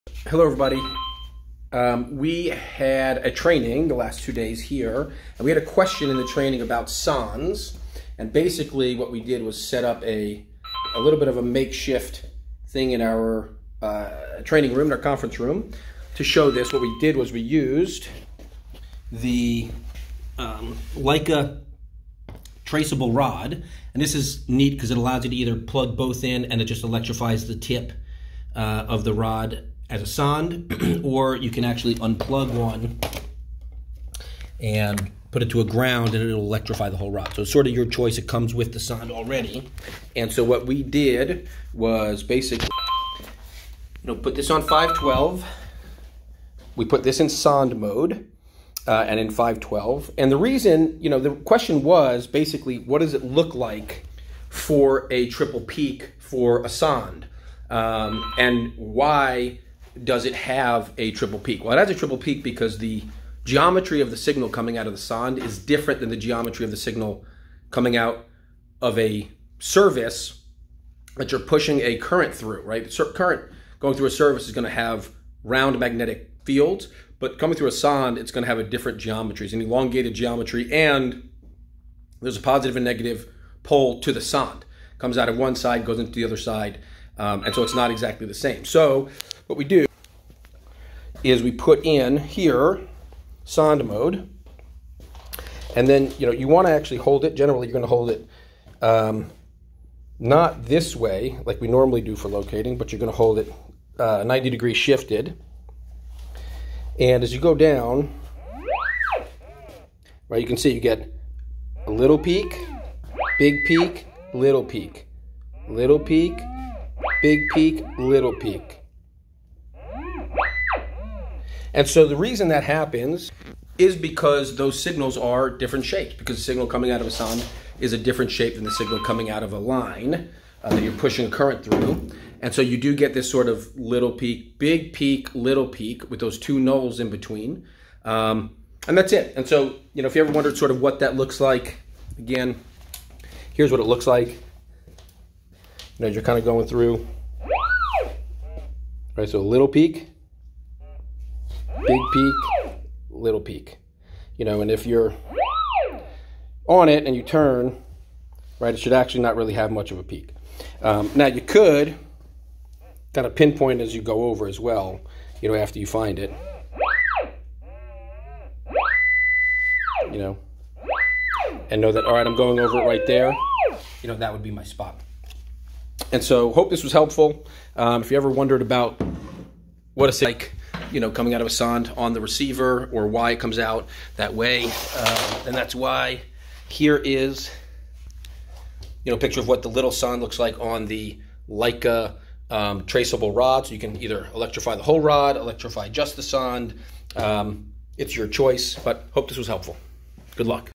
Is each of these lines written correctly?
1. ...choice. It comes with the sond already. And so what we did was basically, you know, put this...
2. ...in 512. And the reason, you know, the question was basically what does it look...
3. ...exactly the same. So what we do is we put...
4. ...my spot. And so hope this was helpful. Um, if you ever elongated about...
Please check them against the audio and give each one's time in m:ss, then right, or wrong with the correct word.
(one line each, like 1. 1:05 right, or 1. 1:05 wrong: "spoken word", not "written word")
1. 0:37 right
2. 0:49 right
3. 1:27 right
4. 2:54 wrong: "wondered", not "elongated".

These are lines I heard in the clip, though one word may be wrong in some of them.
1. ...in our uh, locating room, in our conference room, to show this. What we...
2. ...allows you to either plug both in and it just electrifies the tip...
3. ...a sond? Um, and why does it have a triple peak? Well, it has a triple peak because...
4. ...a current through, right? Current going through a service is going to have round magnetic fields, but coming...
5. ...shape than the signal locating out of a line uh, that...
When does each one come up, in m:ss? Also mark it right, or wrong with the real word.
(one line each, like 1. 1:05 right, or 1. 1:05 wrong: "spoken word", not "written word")
1. 0:12 wrong: "training", not "locating"
2. 0:24 right
3. 0:56 right
4. 1:11 right
5. 2:08 wrong: "coming", not "locating".